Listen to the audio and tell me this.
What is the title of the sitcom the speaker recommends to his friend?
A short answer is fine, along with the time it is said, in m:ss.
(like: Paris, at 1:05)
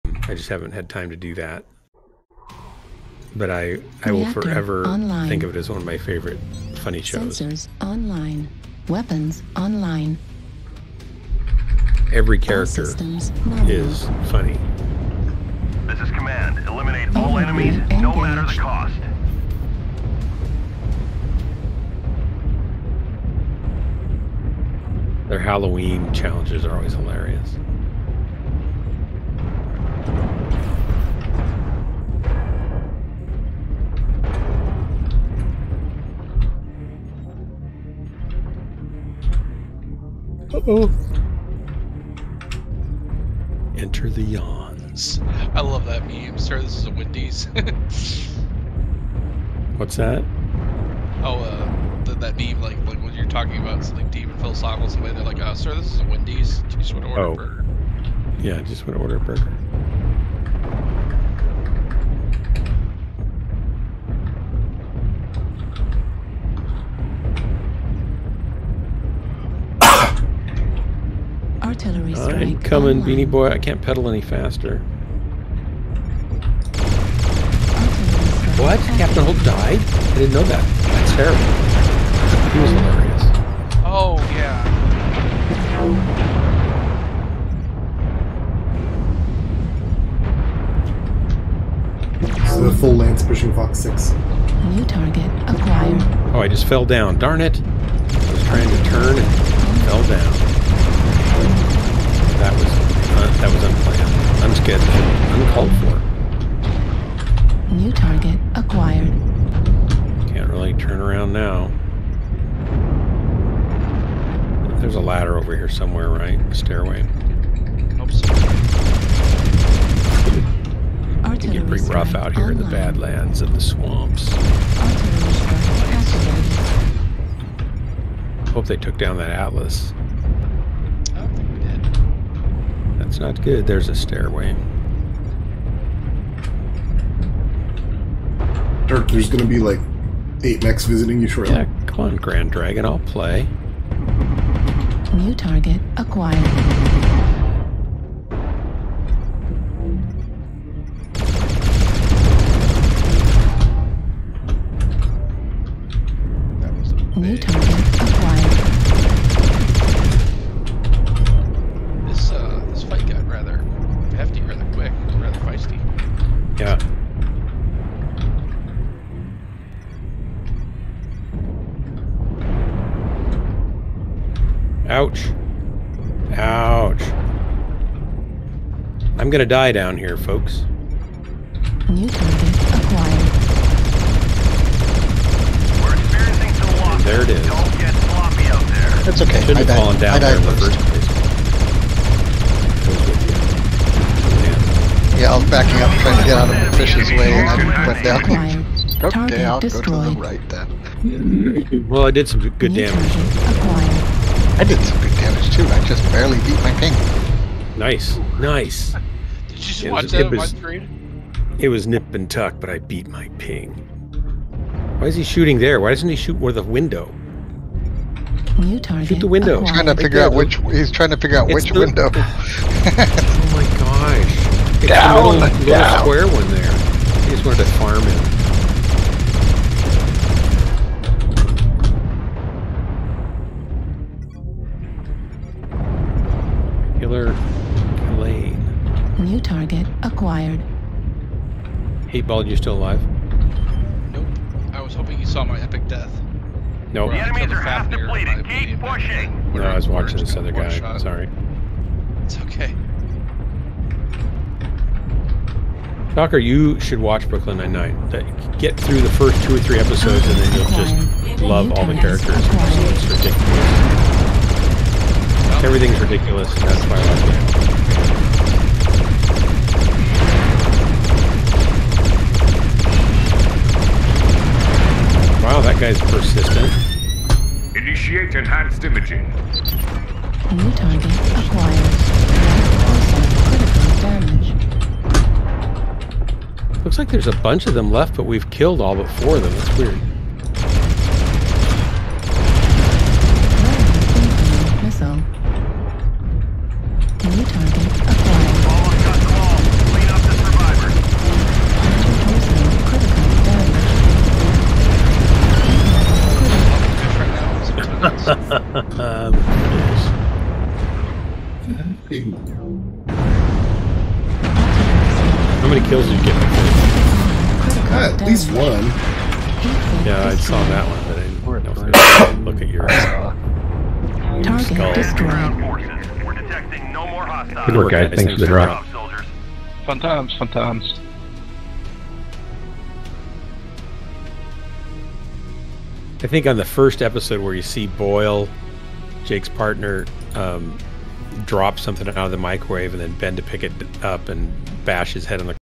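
Brooklyn Nine-Nine, at 4:17.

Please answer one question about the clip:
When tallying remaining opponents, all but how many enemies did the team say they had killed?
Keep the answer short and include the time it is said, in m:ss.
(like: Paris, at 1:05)
4, at 4:49.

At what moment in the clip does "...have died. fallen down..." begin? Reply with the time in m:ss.
3:09.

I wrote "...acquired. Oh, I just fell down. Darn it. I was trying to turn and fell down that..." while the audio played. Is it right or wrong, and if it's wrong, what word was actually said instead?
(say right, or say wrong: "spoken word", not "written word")
right.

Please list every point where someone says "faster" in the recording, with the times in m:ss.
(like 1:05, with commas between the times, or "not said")
1:14.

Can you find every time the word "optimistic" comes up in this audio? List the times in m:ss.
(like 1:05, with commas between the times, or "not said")
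not said.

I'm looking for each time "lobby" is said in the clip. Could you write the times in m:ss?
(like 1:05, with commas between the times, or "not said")
not said.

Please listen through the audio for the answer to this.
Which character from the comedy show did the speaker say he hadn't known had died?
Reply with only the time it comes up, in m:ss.
1:18.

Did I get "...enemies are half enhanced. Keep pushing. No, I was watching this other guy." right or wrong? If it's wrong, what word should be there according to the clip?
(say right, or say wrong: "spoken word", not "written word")
wrong: "depleted", not "enhanced".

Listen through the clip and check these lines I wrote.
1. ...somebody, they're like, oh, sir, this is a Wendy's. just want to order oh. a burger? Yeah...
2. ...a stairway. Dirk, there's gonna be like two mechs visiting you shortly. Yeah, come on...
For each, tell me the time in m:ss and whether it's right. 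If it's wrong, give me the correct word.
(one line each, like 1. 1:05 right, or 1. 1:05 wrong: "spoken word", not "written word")
1. 0:54 right
2. 2:13 wrong: "eight", not "two".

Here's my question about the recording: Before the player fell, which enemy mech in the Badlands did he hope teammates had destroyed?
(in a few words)
Atlas.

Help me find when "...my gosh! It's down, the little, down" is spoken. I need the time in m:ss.
3:43.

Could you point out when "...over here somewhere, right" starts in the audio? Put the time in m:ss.
1:55.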